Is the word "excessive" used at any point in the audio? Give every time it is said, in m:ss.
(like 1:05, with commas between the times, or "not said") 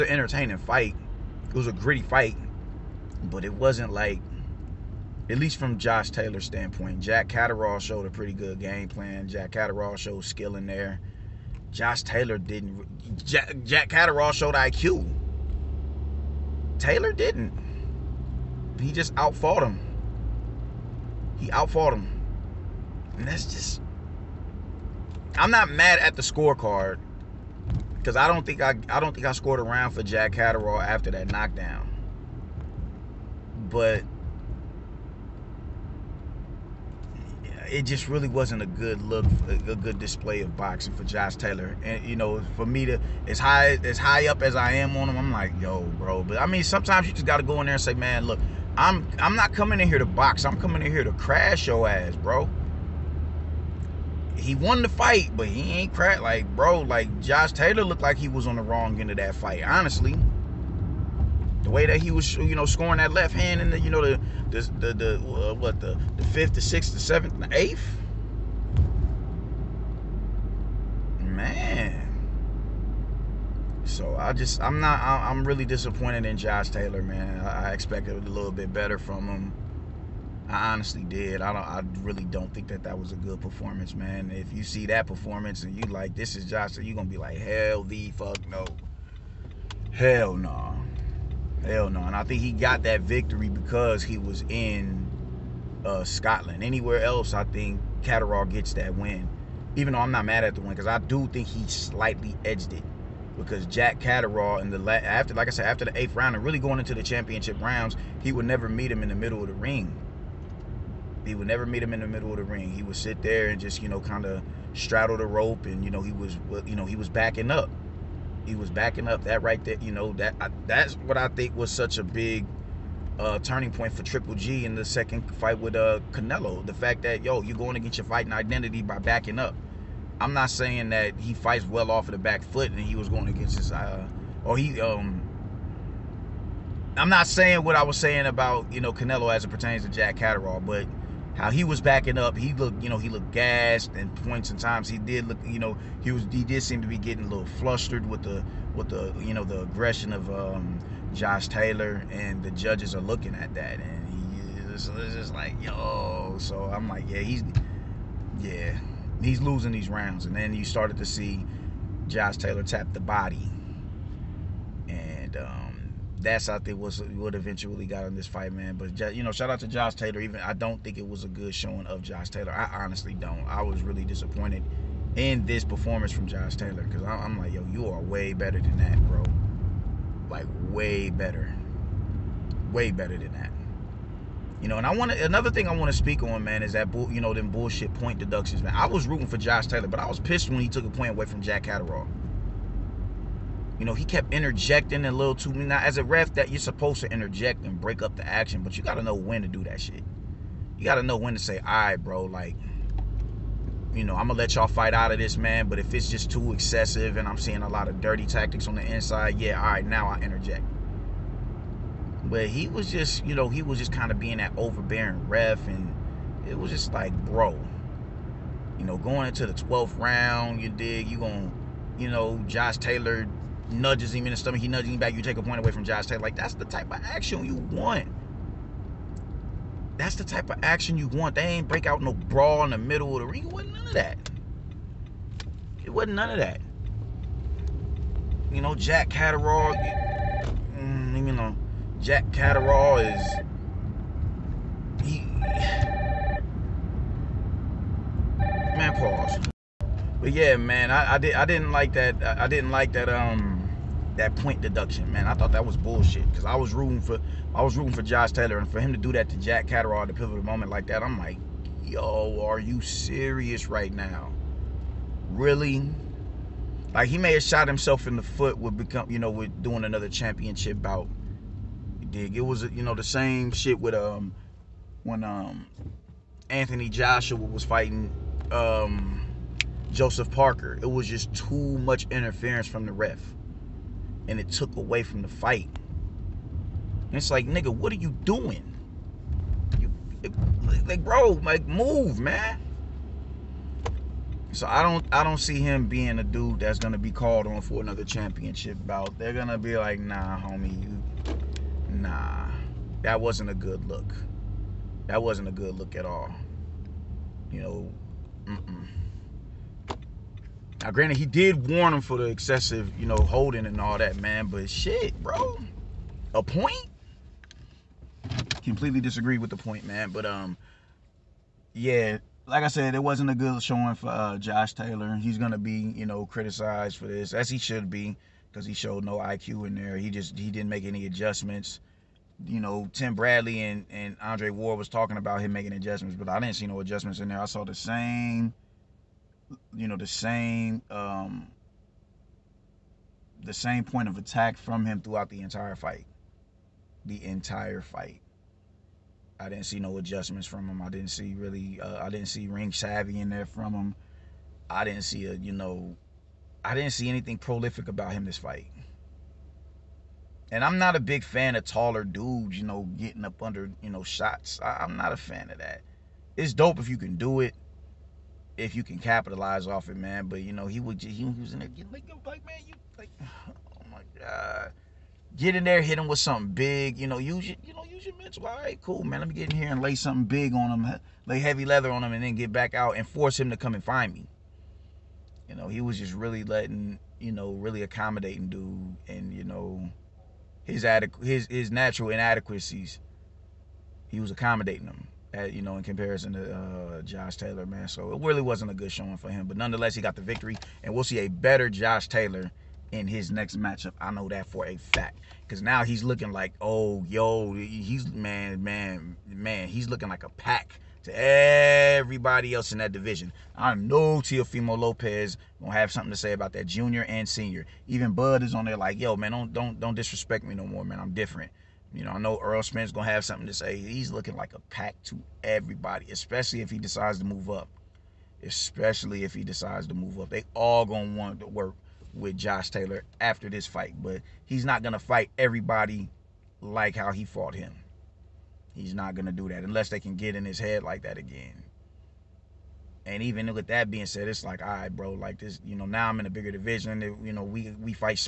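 3:26, 5:12.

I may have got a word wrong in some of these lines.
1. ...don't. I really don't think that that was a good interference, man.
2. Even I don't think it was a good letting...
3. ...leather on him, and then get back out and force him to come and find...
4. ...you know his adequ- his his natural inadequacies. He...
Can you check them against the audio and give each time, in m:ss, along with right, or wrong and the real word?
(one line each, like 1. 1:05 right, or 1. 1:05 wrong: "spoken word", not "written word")
1. 1:21 wrong: "performance", not "interference"
2. 2:50 wrong: "showing", not "letting"
3. 6:21 right
4. 6:29 right.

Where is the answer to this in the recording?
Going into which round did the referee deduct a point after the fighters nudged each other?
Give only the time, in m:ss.
3:39.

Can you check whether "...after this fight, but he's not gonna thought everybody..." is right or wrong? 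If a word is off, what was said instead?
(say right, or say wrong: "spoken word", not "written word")
wrong: "fight", not "thought".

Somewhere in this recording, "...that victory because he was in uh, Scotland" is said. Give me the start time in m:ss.
1:32.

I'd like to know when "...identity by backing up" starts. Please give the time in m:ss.
2:08.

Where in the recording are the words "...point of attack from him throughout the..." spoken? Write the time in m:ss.
5:43.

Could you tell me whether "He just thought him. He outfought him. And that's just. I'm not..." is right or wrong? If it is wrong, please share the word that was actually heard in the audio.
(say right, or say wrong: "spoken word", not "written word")
wrong: "outfought", not "thought".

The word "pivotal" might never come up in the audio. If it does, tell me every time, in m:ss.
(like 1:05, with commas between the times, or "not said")
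4:20.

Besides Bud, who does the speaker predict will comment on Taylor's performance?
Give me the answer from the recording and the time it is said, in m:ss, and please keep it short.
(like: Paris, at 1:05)
Earl Smith, at 7:02.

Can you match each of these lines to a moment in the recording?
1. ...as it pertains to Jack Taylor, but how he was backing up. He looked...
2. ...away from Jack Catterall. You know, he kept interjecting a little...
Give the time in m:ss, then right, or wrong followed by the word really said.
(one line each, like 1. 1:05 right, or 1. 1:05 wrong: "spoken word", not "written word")
1. 2:19 wrong: "Catterall", not "Taylor"
2. 3:11 right.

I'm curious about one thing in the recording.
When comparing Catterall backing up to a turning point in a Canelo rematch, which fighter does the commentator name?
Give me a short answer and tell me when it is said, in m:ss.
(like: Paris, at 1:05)
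Triple G, at 2:04.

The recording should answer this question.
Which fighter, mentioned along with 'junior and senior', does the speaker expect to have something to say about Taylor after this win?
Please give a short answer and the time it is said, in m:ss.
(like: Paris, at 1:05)
Teofimo Lopez, at 6:54.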